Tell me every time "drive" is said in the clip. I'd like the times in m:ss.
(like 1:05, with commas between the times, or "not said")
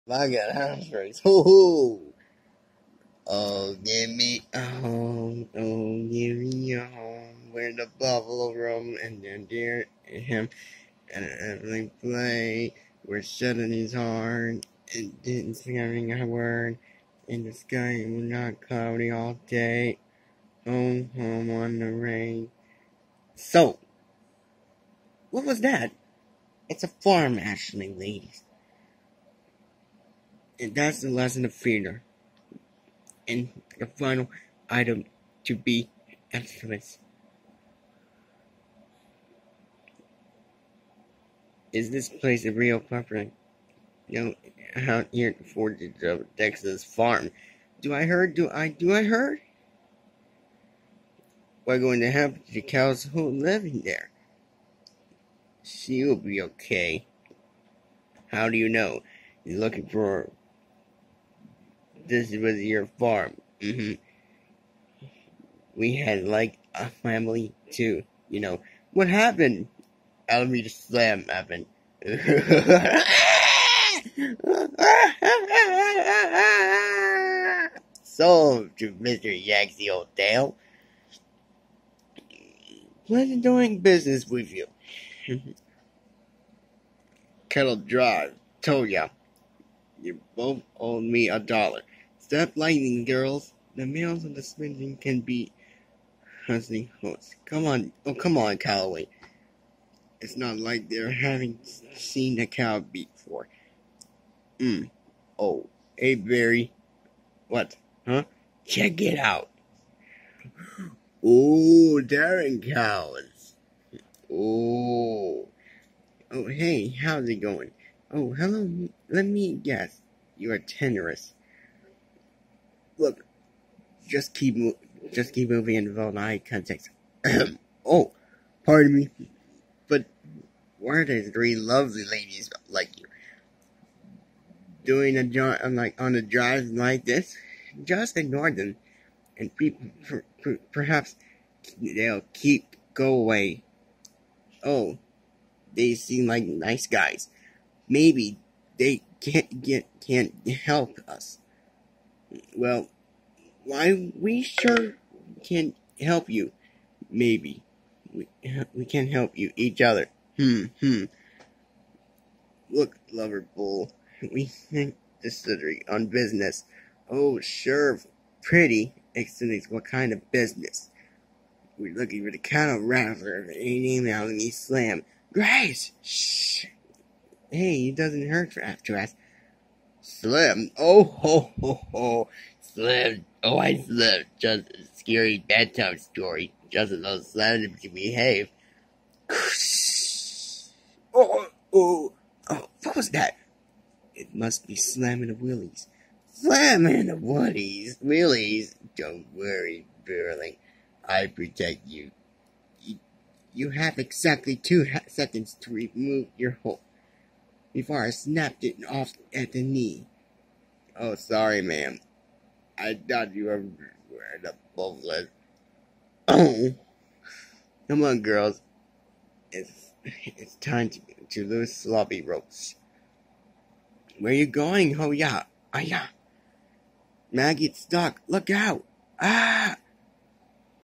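1:27, 2:16.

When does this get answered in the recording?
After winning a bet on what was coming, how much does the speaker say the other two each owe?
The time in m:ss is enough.
1:31.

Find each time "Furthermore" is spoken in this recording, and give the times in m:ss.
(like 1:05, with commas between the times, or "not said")
not said.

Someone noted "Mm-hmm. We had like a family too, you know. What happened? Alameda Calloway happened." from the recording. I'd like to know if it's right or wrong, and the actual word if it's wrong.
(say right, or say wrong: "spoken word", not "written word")
wrong: "Slim", not "Calloway".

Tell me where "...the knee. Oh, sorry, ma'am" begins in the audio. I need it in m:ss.
3:29.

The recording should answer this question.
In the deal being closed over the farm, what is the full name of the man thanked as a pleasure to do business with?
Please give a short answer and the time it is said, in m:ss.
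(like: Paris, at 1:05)
Yancy O'Del, at 1:18.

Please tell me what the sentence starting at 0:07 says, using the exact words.
Where the buffalo roam and then deer and him and everything play.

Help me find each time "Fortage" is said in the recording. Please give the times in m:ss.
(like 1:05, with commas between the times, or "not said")
0:45.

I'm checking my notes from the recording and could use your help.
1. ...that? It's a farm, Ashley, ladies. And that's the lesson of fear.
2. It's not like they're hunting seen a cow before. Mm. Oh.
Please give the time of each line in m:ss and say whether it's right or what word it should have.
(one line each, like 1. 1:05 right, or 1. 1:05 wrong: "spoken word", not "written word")
1. 0:25 right
2. 1:40 wrong: "having", not "hunting".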